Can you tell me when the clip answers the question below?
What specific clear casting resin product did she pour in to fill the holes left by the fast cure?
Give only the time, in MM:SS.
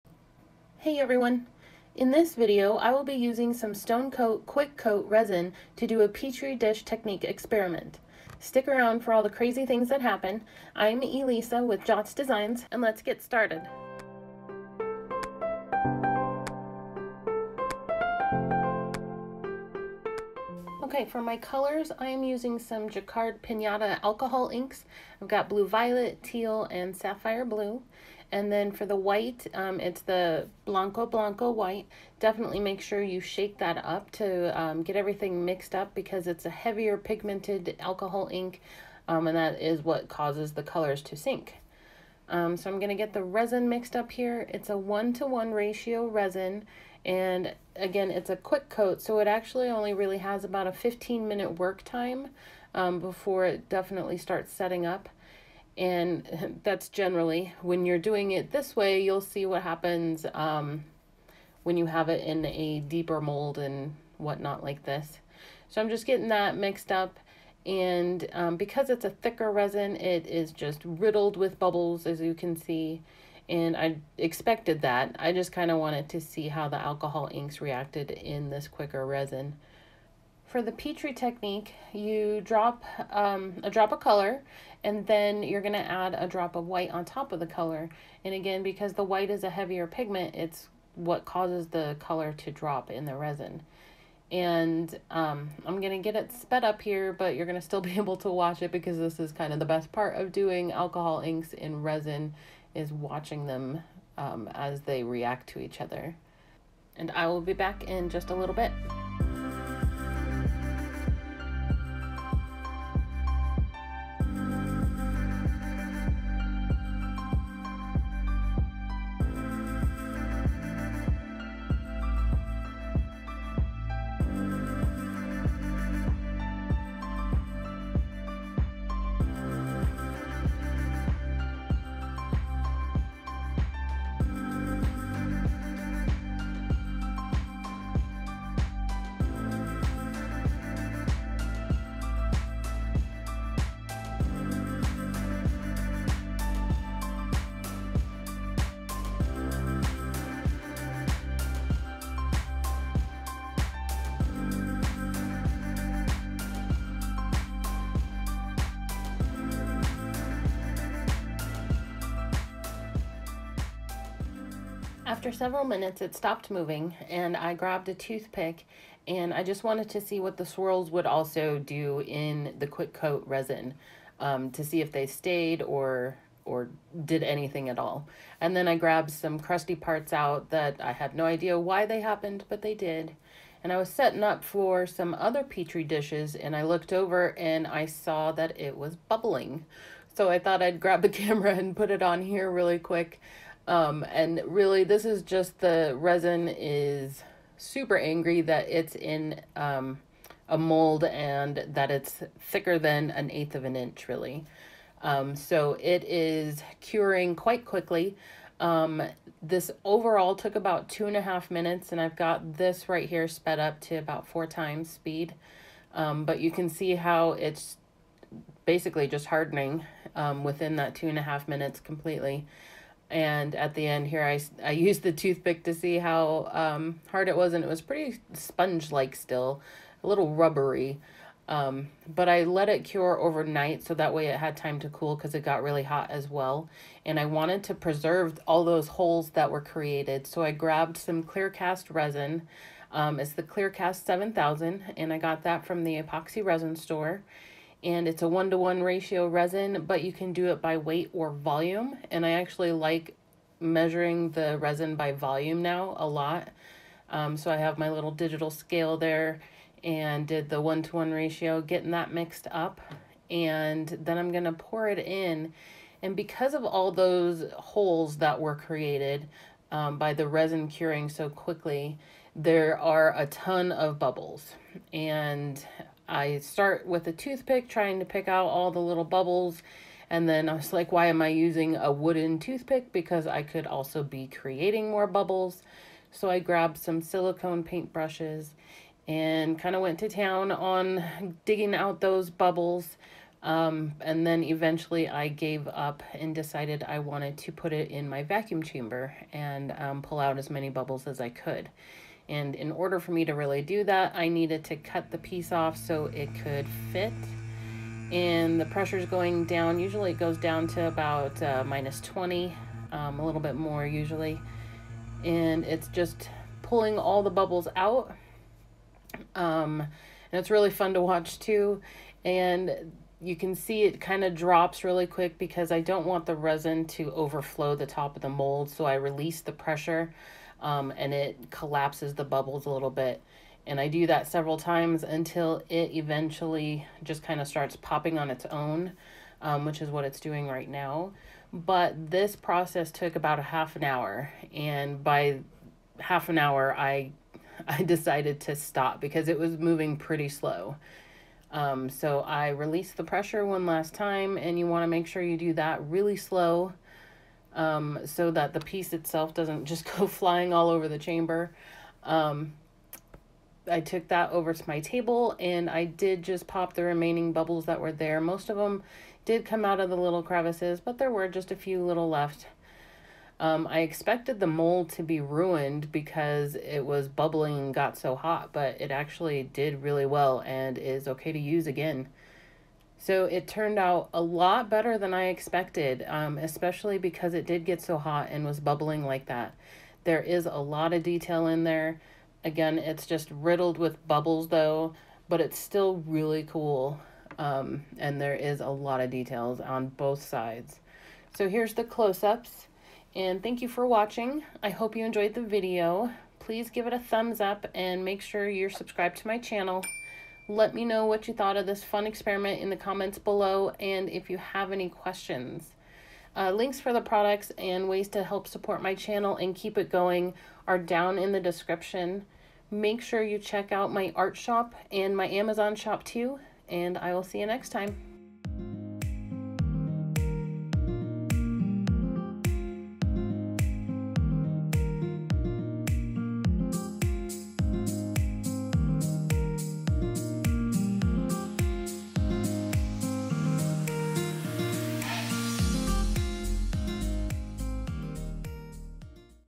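04:03.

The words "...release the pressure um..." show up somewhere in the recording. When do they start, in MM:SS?
05:28.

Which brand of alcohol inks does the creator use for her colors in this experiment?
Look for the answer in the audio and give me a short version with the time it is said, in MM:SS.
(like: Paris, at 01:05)
Jacquard Pinata, at 00:22.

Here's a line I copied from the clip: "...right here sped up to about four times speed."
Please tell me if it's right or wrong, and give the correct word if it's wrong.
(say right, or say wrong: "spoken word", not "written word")
right.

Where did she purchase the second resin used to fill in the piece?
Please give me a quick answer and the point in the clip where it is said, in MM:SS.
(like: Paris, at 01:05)
the epoxy resin store, at 04:05.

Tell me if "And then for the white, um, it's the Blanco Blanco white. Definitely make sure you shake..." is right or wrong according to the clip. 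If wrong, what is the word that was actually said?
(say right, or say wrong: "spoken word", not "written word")
right.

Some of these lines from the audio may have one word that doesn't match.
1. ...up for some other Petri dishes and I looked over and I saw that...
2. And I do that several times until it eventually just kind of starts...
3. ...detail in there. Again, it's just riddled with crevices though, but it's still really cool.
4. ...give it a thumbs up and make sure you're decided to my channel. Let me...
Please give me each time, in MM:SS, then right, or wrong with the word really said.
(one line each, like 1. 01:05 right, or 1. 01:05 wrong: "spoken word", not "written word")
1. 03:04 right
2. 05:33 right
3. 06:31 wrong: "bubbles", not "crevices"
4. 06:46 wrong: "subscribed", not "decided".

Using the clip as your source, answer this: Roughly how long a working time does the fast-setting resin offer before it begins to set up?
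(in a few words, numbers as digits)
15 minutes.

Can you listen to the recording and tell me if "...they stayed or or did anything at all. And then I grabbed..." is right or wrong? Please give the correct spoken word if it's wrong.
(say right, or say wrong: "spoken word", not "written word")
right.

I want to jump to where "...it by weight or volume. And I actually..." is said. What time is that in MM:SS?
04:10.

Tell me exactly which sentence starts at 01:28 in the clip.
And again, because the white is a heavier pigment, it's what causes the color to drop in the resin.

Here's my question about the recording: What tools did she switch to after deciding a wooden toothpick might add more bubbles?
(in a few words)
silicone paintbrushes.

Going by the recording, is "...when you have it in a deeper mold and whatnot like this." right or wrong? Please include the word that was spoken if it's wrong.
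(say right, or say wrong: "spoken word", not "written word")
right.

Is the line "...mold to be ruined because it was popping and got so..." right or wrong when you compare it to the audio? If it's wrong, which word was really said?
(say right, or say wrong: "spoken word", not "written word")
wrong: "bubbling", not "popping".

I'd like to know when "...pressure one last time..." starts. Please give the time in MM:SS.
05:53.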